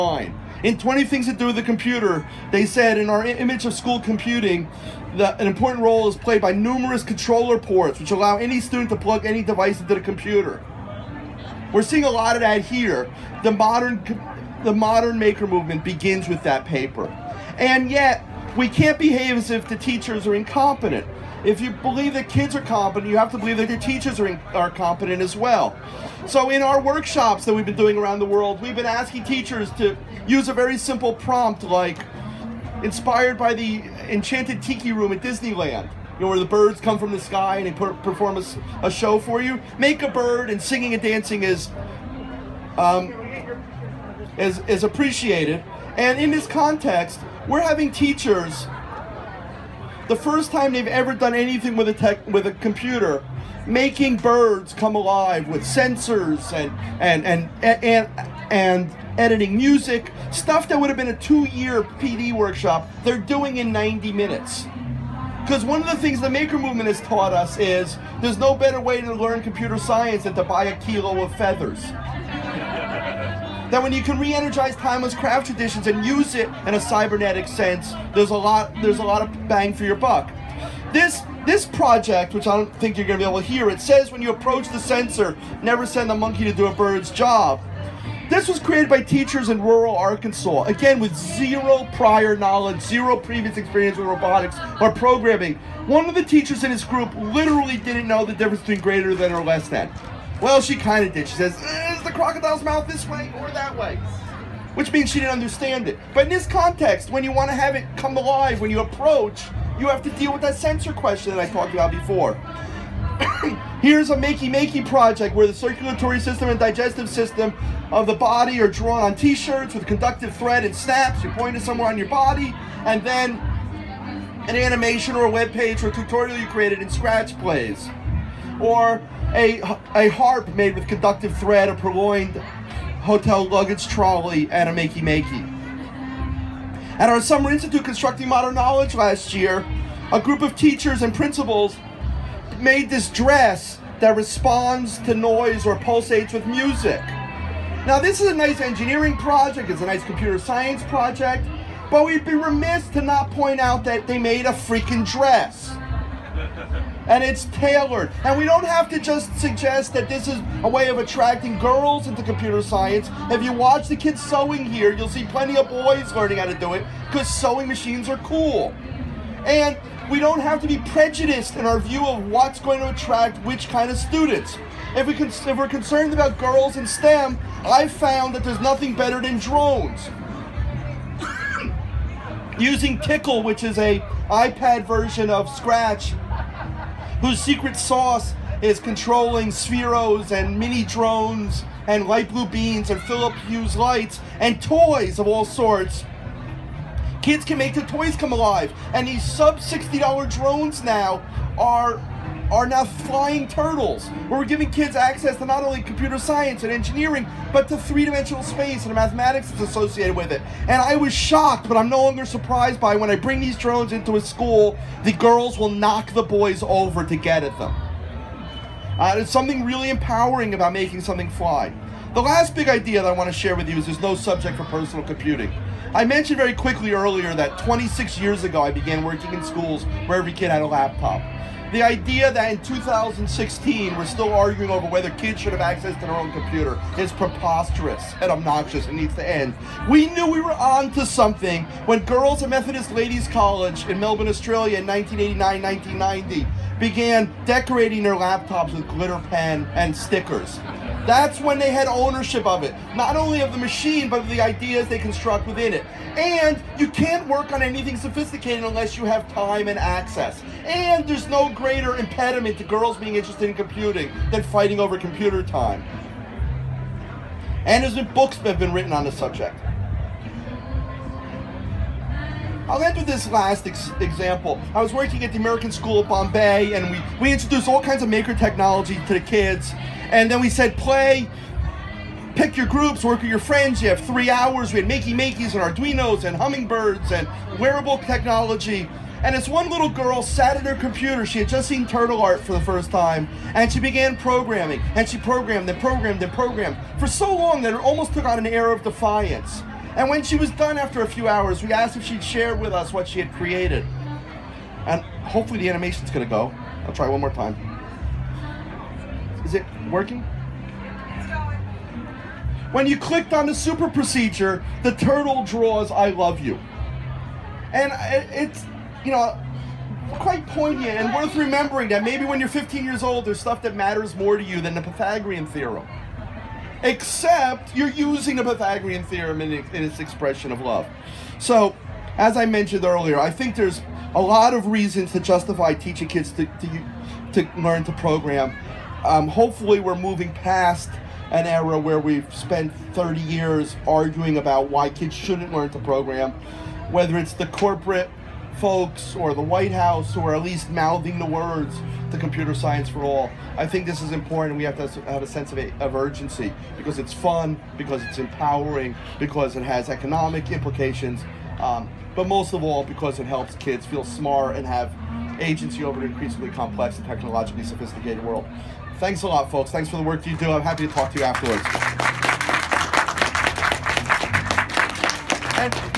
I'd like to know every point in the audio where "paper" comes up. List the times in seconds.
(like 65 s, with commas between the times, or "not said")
16 s.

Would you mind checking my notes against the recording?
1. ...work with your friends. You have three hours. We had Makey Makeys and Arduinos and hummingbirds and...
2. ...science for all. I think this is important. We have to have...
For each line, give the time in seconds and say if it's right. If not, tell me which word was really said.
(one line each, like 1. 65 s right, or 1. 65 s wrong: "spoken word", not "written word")
1. 283 s right
2. 352 s right.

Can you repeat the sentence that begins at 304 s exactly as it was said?
And hopefully the animation's gonna go.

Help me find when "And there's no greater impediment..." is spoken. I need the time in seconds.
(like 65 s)
260 s.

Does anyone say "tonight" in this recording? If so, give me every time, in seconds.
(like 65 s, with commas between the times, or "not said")
not said.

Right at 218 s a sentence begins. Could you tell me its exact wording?
Uh, something really empowering about making something fly.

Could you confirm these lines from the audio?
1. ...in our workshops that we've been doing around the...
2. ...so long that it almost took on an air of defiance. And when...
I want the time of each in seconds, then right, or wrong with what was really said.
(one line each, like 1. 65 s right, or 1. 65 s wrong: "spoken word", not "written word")
1. 26 s right
2. 297 s right.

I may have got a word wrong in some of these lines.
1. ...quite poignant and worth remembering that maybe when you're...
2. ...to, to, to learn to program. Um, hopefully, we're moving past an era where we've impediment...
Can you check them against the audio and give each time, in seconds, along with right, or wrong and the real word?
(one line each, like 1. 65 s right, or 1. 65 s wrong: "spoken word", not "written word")
1. 320 s right
2. 336 s wrong: "spent", not "impediment".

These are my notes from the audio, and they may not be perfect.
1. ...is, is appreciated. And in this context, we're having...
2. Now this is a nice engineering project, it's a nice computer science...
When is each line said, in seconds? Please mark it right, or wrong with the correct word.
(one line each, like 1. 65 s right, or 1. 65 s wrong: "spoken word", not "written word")
1. 44 s right
2. 147 s right.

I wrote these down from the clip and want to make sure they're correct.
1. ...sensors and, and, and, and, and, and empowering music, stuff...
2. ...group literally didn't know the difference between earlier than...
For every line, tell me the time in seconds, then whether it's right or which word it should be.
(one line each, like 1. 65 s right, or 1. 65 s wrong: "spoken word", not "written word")
1. 55 s wrong: "editing", not "empowering"
2. 96 s wrong: "greater", not "earlier".